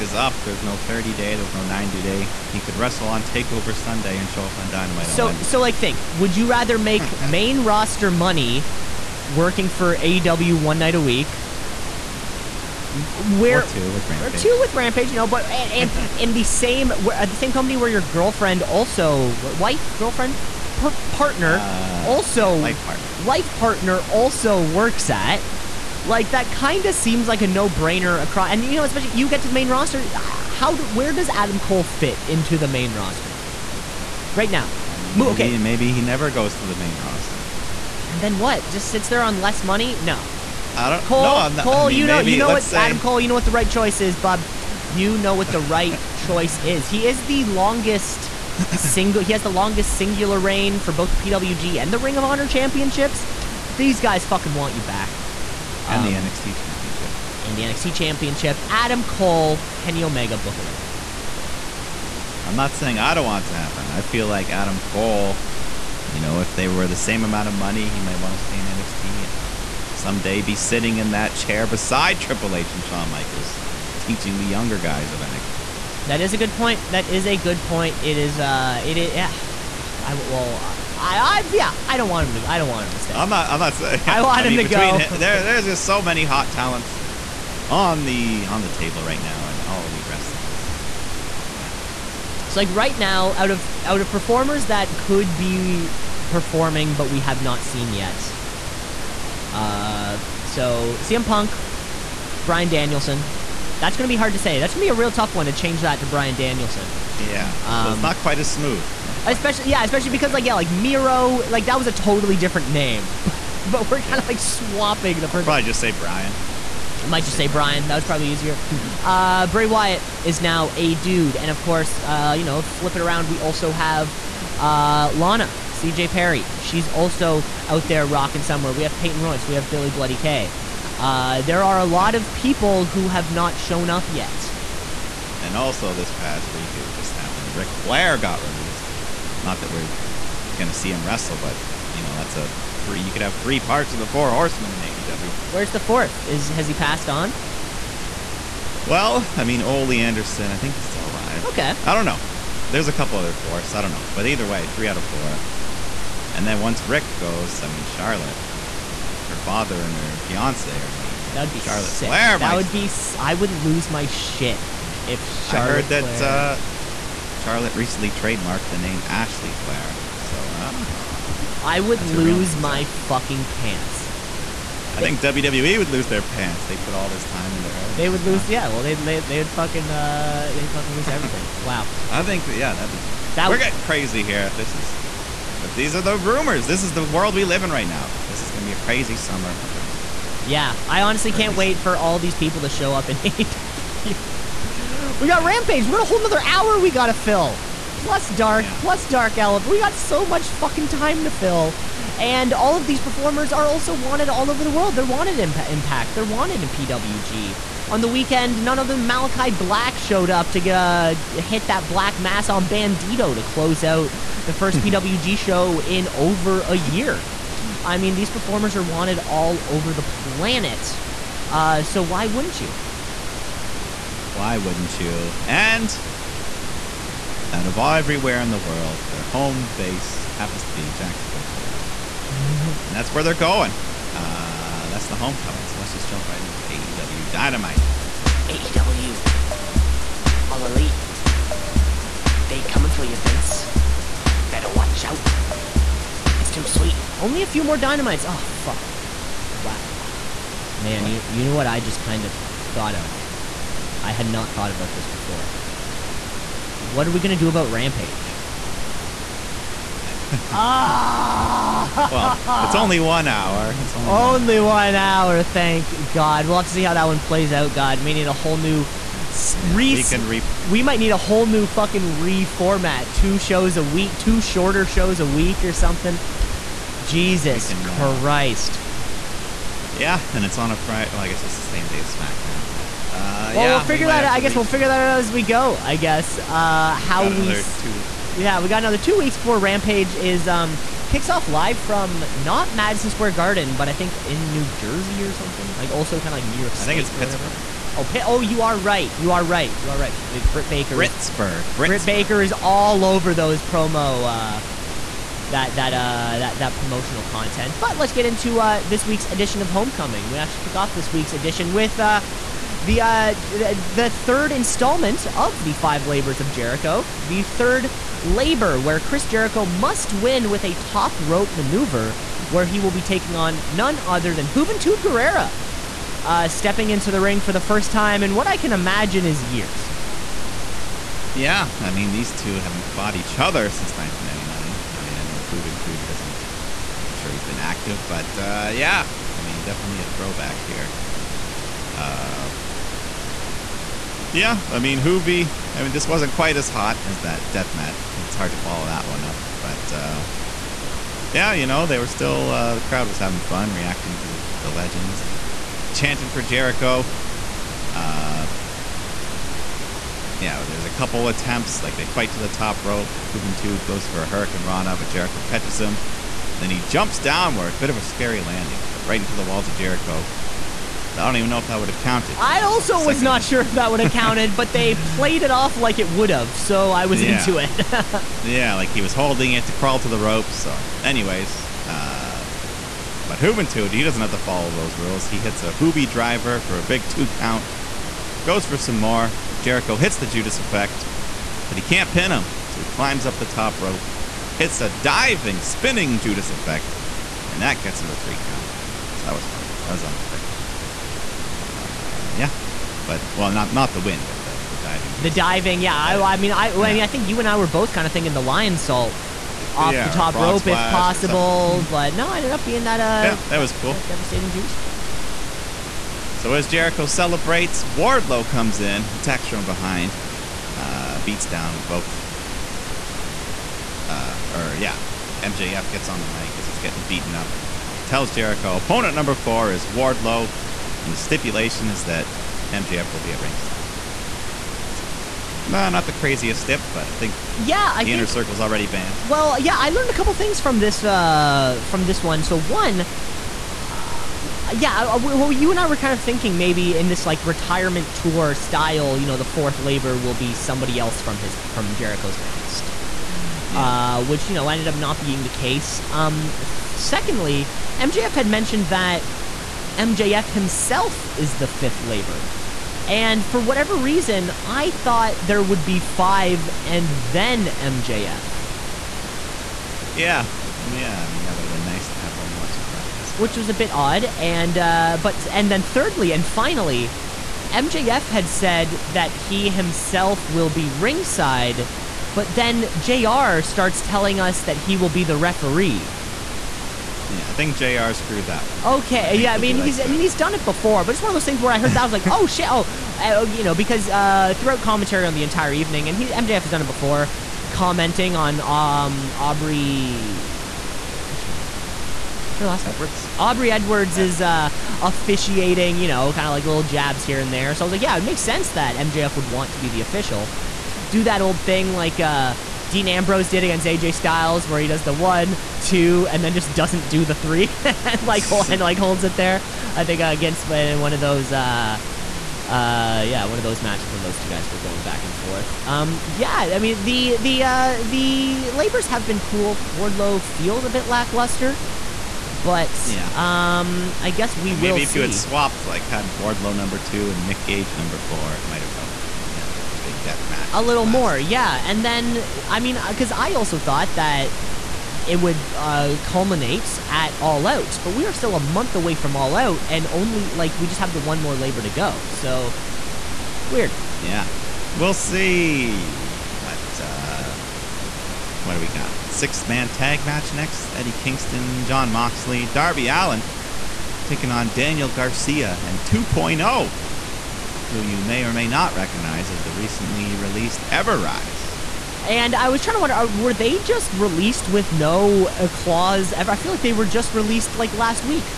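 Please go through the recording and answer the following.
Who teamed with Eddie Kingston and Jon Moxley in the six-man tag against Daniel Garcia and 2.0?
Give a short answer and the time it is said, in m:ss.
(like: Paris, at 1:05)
Darby Allin, at 9:22.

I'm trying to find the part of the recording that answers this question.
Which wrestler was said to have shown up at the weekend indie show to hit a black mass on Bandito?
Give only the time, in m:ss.
3:28.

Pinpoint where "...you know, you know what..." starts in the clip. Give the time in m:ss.
0:41.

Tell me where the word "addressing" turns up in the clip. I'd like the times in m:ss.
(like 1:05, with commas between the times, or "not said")
not said.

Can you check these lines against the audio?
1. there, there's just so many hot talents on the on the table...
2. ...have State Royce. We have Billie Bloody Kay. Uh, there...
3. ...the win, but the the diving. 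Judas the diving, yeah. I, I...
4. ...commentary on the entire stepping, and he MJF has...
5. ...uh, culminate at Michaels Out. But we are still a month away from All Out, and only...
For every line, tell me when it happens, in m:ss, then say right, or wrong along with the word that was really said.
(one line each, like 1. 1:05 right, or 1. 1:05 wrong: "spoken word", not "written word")
1. 1:25 right
2. 2:08 wrong: "Peyton", not "State"
3. 6:43 right
4. 8:14 wrong: "evening", not "stepping"
5. 9:05 wrong: "All", not "Michaels".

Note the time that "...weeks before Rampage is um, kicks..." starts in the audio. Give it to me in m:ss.
4:49.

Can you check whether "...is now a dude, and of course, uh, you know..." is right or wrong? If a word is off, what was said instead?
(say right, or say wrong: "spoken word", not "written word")
right.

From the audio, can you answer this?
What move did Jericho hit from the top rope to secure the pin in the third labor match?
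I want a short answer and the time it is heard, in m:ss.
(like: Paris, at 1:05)
spinning Judas effect, at 6:35.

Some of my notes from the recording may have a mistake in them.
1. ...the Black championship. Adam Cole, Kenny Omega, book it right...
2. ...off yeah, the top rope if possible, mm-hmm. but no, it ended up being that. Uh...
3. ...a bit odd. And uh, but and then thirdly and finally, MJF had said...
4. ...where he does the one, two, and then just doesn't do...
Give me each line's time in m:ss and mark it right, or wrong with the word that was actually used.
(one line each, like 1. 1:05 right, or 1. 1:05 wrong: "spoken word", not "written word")
1. 0:57 wrong: "NXT", not "Black"
2. 6:49 right
3. 7:53 right
4. 8:34 right.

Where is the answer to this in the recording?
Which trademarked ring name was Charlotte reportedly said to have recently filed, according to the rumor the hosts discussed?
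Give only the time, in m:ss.
2:49.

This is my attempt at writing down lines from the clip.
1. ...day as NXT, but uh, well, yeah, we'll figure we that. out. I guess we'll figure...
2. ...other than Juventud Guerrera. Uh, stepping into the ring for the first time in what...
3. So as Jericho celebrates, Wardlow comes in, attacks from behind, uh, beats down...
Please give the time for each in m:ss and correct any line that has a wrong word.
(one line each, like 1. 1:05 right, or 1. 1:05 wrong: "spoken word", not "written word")
1. 4:41 wrong: "SmackDown", not "NXT"
2. 5:23 right
3. 6:56 right.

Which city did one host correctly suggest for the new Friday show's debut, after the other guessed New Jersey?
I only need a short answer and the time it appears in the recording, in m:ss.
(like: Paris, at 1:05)
Pittsburgh, at 4:57.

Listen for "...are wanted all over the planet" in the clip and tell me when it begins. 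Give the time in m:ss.
3:38.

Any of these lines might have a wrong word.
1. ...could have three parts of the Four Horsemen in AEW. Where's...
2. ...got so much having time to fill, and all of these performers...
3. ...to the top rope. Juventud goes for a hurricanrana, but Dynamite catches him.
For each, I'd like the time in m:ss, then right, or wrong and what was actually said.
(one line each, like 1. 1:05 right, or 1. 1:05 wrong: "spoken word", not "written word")
1. 2:23 right
2. 3:19 wrong: "fucking", not "having"
3. 6:02 wrong: "Jericho", not "Dynamite".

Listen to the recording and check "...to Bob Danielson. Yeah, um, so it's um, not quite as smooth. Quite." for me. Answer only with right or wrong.
wrong.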